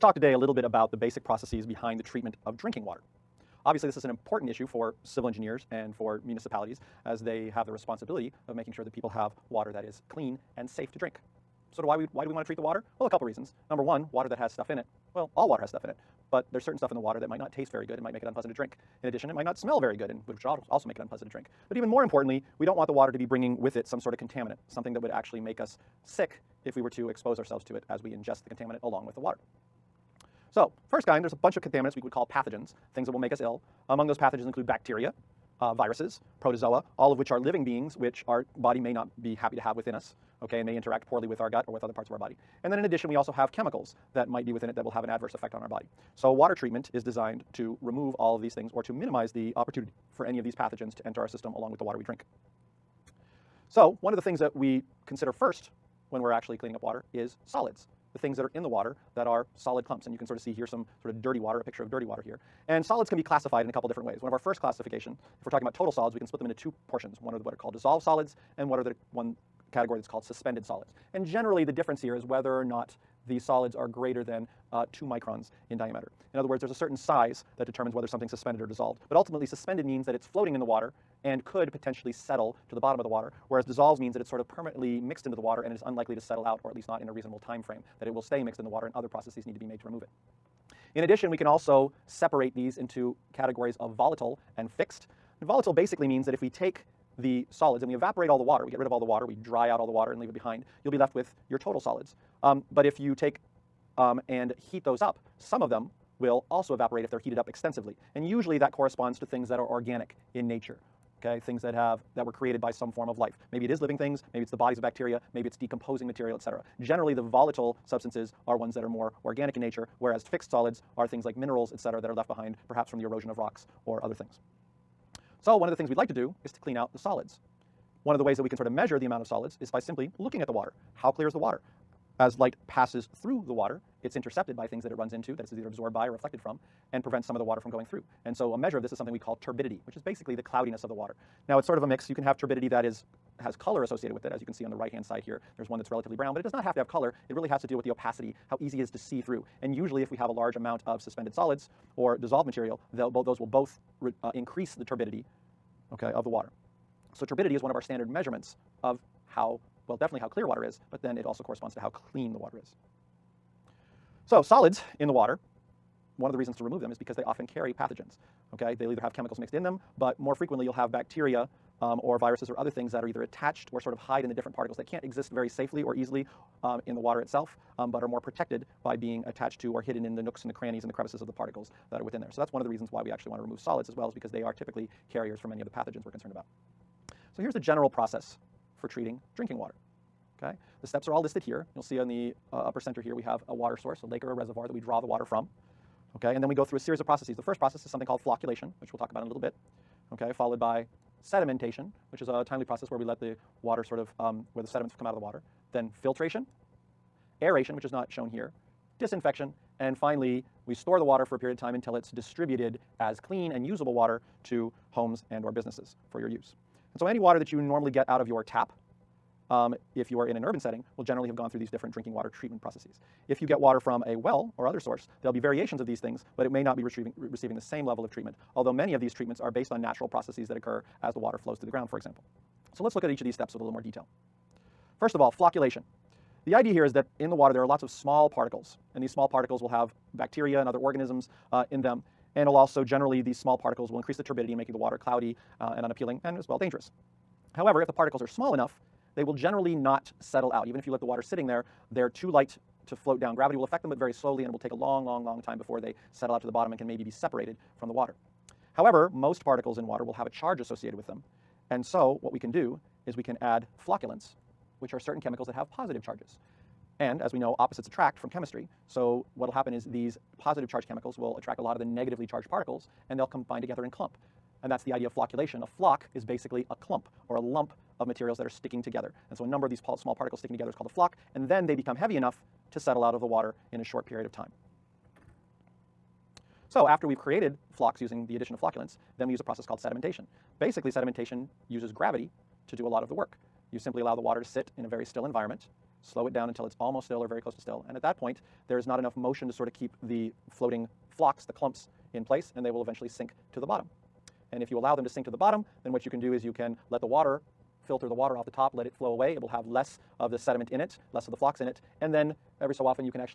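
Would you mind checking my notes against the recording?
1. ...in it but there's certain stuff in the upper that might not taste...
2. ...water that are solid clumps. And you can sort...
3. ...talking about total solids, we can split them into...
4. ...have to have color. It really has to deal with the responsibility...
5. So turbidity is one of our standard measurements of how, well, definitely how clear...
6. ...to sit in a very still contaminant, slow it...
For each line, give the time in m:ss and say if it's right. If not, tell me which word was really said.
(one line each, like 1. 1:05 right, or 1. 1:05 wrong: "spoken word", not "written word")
1. 0:15 wrong: "water", not "upper"
2. 0:58 right
3. 1:05 right
4. 2:26 wrong: "opacity", not "responsibility"
5. 2:37 right
6. 4:54 wrong: "environment", not "contaminant".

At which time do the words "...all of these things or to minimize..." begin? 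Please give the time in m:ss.
0:48.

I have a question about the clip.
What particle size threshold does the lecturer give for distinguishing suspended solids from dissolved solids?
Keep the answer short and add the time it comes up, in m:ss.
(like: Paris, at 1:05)
2 microns, at 1:14.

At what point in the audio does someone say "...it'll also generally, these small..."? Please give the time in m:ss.
4:02.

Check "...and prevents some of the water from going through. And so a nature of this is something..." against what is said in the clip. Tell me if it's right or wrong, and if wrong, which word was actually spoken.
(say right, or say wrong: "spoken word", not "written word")
wrong: "measure", not "nature".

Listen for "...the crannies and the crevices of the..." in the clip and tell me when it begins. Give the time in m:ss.
3:00.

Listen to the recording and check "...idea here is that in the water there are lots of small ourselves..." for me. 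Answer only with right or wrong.
wrong.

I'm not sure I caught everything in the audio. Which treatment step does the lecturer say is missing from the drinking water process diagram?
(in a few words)
Aeration.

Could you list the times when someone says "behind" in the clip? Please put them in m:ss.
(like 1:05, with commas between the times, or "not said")
0:01, 1:40, 2:02.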